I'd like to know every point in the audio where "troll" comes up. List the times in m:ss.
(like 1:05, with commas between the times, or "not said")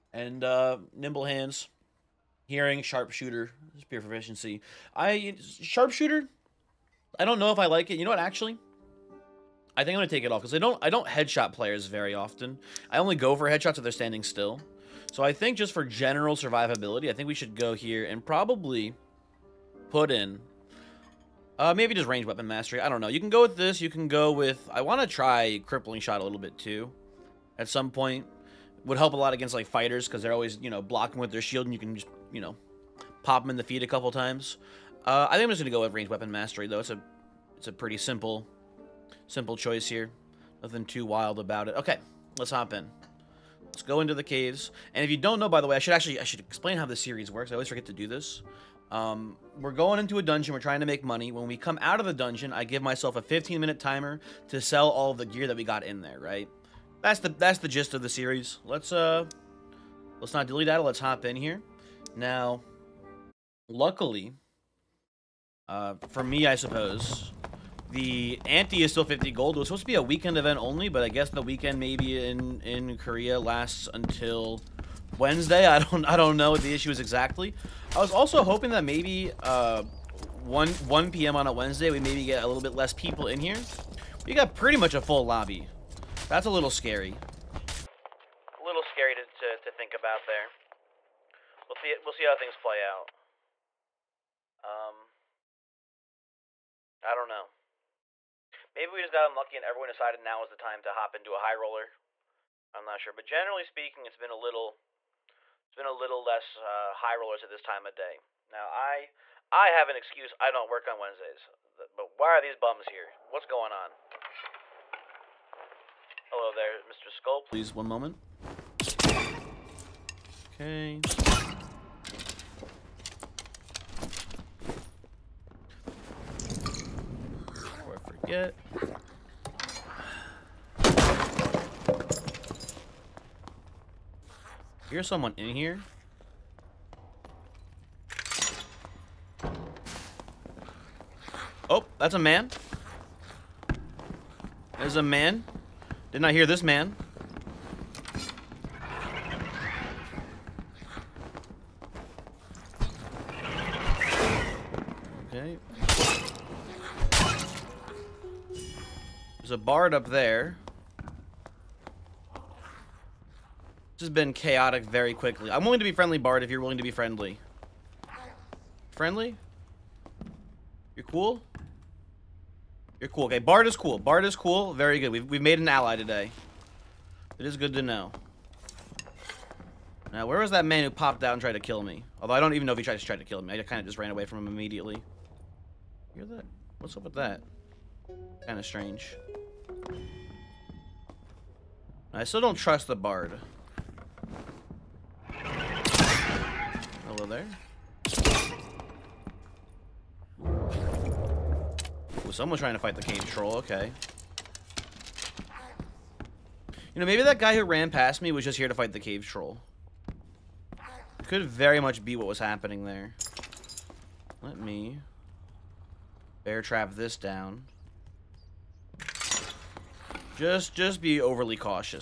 3:23, 3:29.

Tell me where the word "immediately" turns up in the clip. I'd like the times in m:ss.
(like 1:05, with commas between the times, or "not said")
3:04.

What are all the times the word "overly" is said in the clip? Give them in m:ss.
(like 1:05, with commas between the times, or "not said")
3:41.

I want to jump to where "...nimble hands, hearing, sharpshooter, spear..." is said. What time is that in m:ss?
0:00.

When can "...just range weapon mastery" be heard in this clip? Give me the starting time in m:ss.
0:21.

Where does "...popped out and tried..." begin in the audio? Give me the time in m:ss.
3:00.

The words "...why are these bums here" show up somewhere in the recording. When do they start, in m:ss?
1:52.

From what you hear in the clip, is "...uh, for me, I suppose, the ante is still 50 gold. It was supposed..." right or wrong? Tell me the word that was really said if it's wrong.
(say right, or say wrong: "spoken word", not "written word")
right.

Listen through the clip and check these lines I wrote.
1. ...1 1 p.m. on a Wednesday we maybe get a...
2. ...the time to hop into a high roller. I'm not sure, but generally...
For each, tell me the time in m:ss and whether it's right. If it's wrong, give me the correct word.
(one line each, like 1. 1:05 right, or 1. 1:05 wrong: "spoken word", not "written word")
1. 1:20 right
2. 1:40 right.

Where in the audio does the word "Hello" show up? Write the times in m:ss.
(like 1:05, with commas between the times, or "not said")
1:56, 3:17.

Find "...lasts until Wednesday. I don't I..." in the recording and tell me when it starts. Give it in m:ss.
1:13.